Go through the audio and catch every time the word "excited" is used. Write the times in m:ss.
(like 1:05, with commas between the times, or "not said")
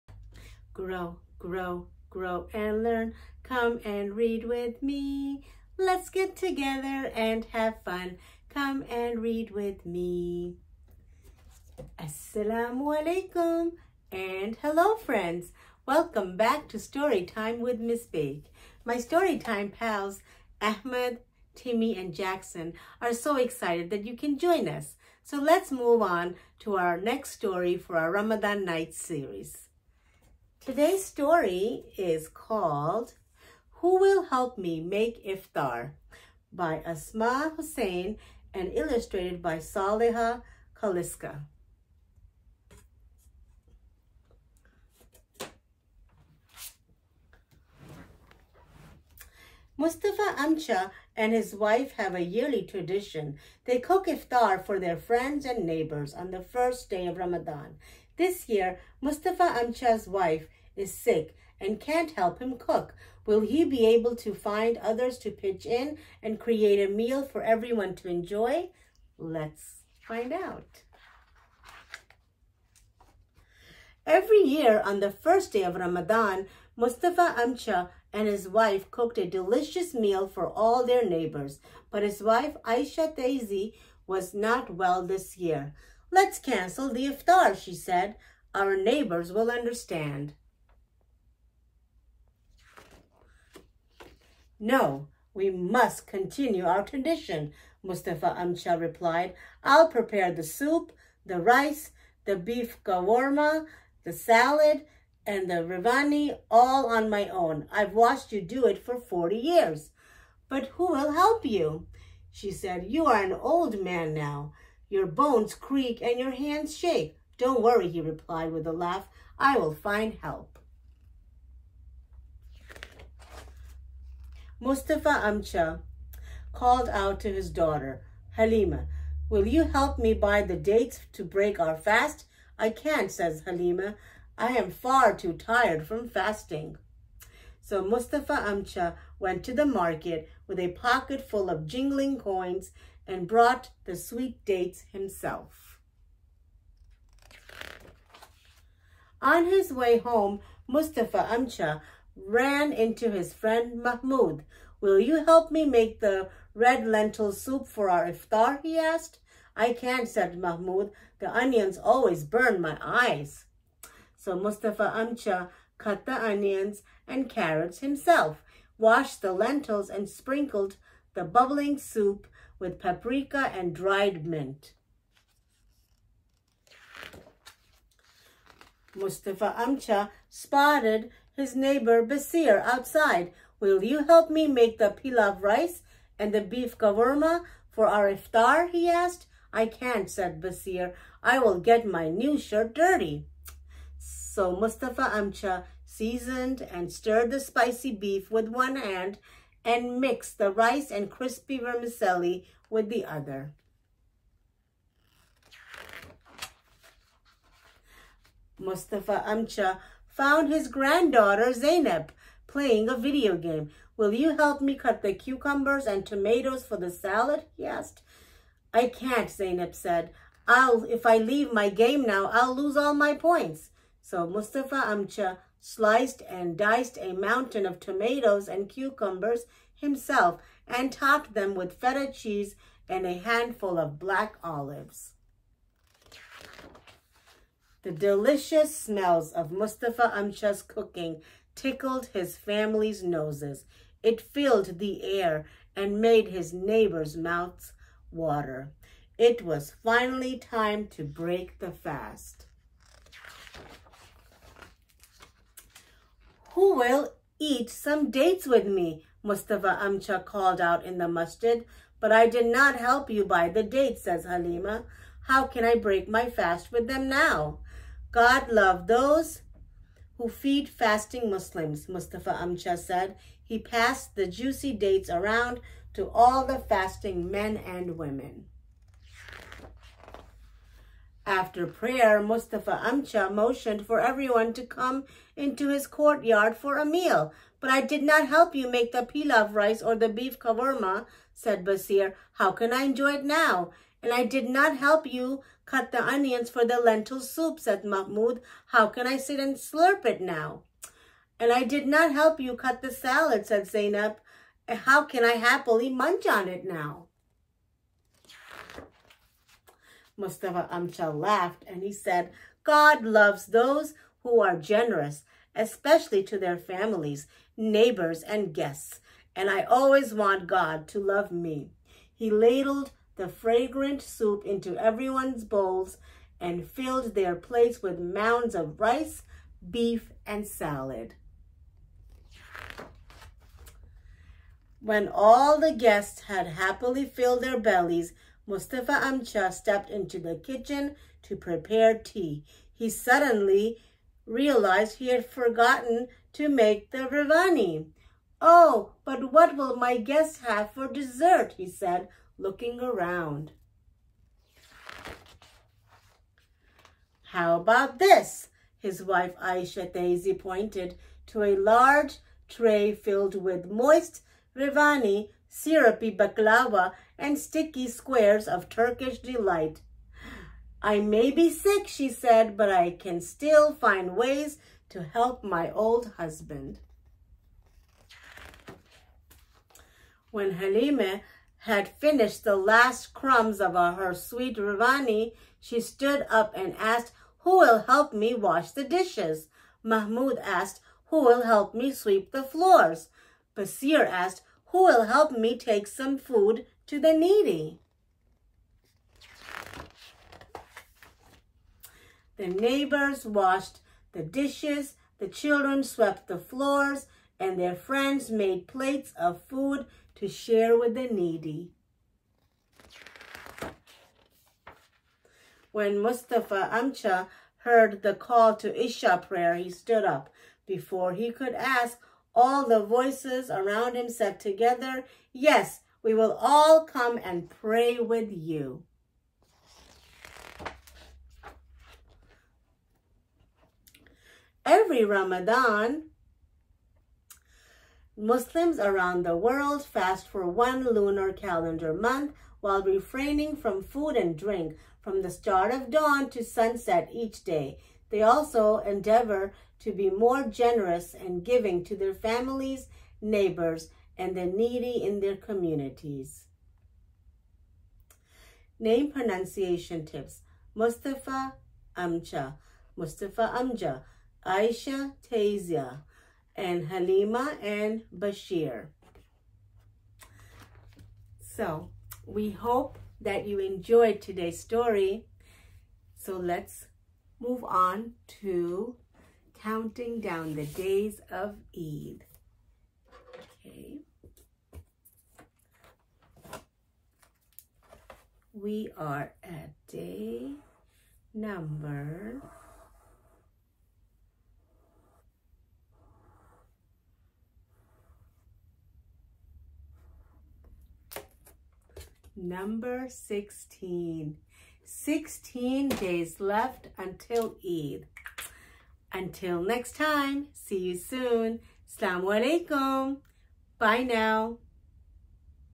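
0:23.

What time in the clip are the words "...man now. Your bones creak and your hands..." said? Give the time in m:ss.
1:53.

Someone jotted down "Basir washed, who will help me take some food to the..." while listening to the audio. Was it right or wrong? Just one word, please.
wrong.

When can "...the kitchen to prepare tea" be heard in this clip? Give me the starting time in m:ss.
5:40.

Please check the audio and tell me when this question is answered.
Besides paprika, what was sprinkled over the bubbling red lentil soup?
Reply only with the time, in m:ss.
2:53.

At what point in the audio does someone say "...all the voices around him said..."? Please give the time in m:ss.
7:02.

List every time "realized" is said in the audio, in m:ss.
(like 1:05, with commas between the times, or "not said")
5:44.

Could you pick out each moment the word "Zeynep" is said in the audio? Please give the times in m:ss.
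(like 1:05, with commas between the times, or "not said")
3:31, 3:39, 5:03.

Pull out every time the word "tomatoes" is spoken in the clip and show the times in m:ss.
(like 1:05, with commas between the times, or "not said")
3:36, 3:47.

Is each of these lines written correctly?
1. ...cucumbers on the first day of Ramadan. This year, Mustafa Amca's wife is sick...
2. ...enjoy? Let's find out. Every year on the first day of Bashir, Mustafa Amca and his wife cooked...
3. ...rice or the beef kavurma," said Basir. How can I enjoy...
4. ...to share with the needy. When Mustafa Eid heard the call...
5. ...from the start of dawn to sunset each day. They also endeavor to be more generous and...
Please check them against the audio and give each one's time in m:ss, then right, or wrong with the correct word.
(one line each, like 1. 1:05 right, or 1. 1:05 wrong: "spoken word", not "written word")
1. 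0:55 wrong: "neighbors", not "cucumbers"
2. 1:08 wrong: "Ramadan", not "Bashir"
3. 4:49 right
4. 6:50 wrong: "Amca", not "Eid"
5. 7:25 right.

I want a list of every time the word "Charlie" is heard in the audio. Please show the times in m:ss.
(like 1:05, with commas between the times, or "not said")
not said.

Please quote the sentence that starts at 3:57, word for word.
The delicious smells of Mustafa Amca's cooking tickled his family's noses.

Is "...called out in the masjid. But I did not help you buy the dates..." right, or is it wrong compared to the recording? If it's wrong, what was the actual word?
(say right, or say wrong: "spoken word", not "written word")
right.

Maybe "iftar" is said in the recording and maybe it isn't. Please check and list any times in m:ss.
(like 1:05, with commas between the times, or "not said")
0:35, 0:54, 1:27, 2:38, 3:08.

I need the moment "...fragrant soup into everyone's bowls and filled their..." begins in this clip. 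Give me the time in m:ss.
5:23.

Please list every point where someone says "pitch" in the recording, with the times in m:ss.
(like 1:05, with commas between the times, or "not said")
1:05.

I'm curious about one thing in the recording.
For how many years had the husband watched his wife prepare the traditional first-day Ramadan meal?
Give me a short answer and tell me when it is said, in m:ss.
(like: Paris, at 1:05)
40, at 1:48.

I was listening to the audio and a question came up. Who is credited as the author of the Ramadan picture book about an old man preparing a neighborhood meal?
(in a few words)
Asmaa Hussein.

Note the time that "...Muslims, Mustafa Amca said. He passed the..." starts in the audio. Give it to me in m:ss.
4:31.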